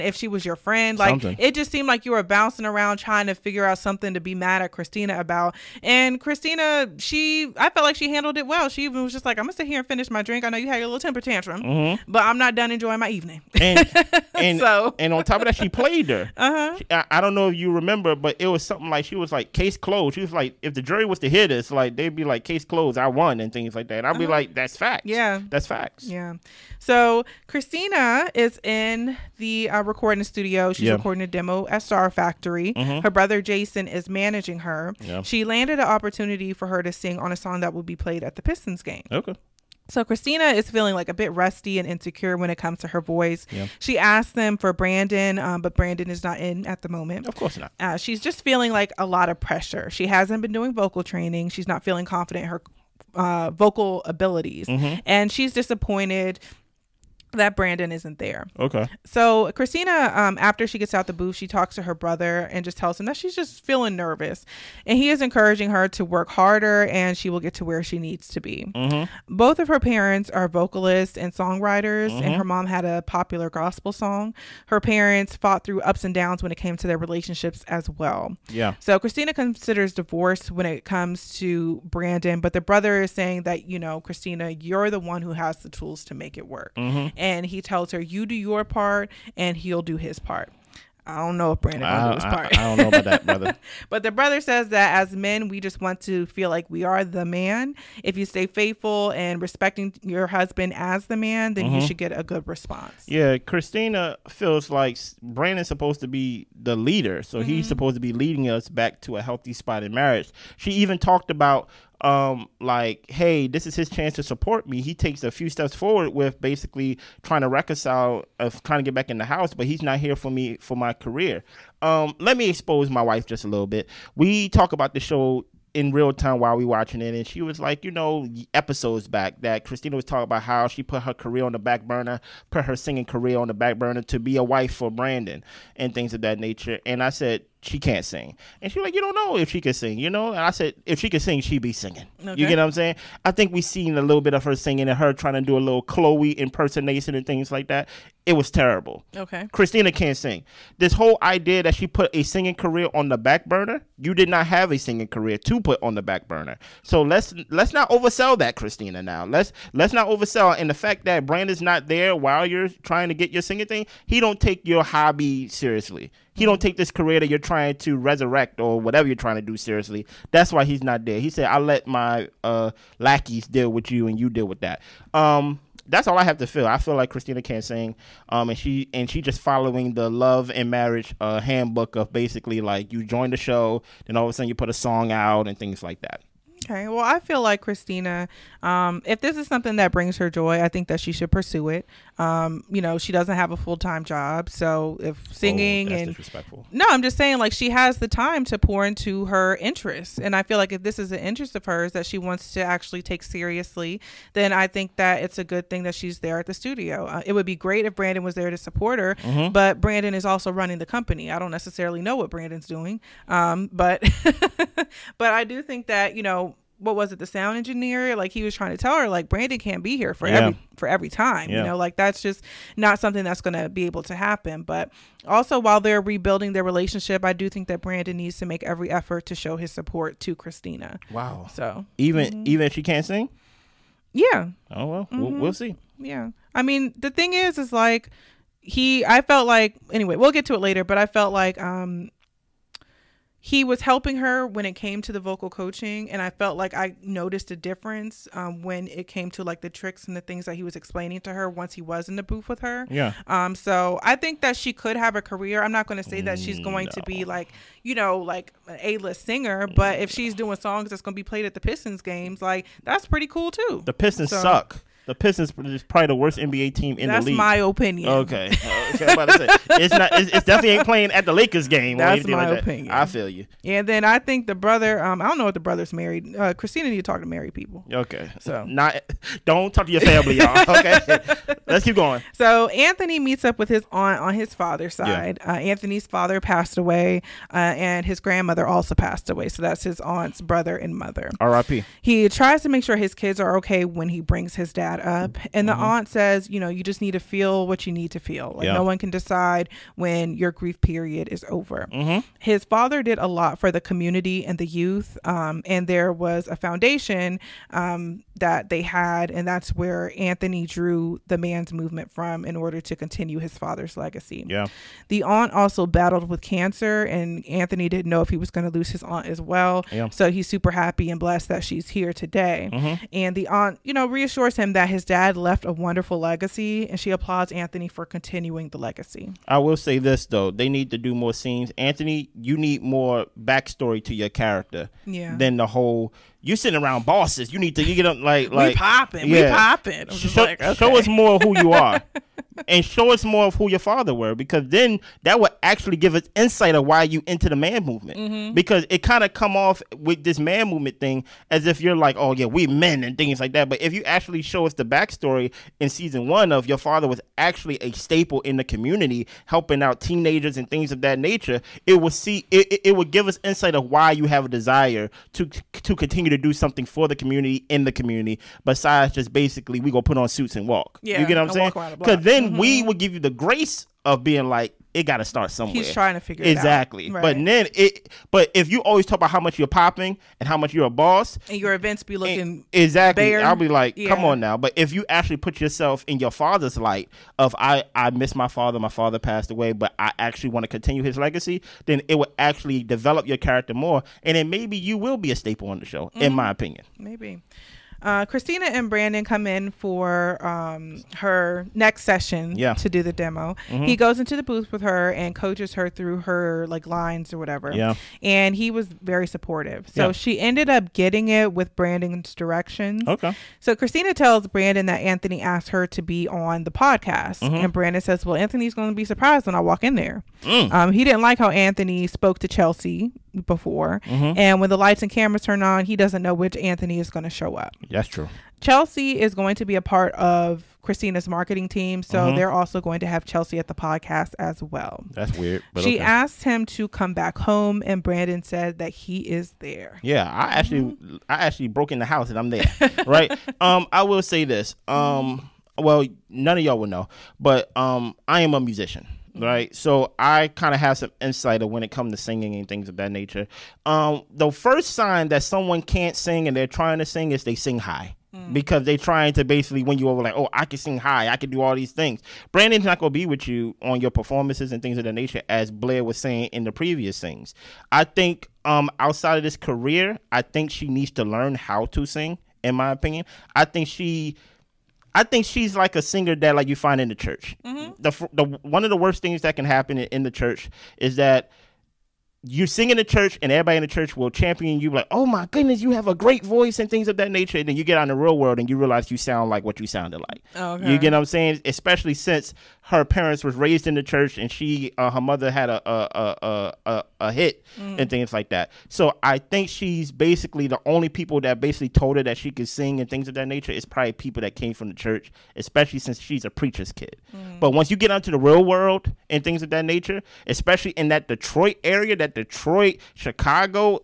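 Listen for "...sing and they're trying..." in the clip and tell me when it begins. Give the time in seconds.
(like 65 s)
456 s.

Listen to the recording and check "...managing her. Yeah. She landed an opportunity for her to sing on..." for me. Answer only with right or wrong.
right.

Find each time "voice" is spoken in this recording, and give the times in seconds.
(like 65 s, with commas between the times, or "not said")
43 s, 486 s.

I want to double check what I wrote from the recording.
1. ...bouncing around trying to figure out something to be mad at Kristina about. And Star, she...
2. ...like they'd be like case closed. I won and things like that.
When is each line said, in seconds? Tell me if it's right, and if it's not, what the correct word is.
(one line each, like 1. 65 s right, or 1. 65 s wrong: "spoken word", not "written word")
1. 2 s wrong: "Kristina", not "Star"
2. 21 s right.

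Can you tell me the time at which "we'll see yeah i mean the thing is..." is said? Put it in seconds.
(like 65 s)
235 s.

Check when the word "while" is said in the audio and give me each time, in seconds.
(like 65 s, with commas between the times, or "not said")
126 s, 162 s, 225 s.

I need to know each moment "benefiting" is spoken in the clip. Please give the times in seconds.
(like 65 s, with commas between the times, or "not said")
not said.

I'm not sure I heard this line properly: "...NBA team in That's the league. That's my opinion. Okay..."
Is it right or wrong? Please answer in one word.
right.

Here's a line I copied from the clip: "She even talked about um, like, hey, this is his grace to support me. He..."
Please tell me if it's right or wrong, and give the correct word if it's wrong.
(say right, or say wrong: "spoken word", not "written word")
wrong: "chance", not "grace".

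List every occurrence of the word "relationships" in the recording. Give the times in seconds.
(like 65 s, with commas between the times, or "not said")
76 s, 226 s.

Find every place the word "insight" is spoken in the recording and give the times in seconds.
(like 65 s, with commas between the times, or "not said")
346 s, 363 s, 451 s.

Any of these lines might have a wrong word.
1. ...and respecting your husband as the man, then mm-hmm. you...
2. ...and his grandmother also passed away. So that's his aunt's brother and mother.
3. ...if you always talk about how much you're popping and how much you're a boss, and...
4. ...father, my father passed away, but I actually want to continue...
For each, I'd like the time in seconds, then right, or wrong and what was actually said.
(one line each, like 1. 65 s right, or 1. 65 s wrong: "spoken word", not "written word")
1. 99 s right
2. 287 s right
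3. 378 s right
4. 388 s right.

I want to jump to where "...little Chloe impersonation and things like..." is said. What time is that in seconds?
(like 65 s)
145 s.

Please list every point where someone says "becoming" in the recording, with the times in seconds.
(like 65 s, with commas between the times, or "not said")
not said.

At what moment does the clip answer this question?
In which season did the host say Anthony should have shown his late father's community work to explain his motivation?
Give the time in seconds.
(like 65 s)
355 s.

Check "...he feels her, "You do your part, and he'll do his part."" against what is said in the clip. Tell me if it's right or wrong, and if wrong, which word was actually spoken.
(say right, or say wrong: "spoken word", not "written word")
wrong: "tells", not "feels".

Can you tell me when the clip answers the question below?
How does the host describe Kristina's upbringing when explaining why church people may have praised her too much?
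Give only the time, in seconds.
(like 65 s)
506 s.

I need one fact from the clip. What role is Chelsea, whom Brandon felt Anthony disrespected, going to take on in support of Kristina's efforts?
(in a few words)
Marketing team.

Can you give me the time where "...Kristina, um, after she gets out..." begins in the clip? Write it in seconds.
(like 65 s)
59 s.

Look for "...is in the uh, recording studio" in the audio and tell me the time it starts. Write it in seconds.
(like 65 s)
28 s.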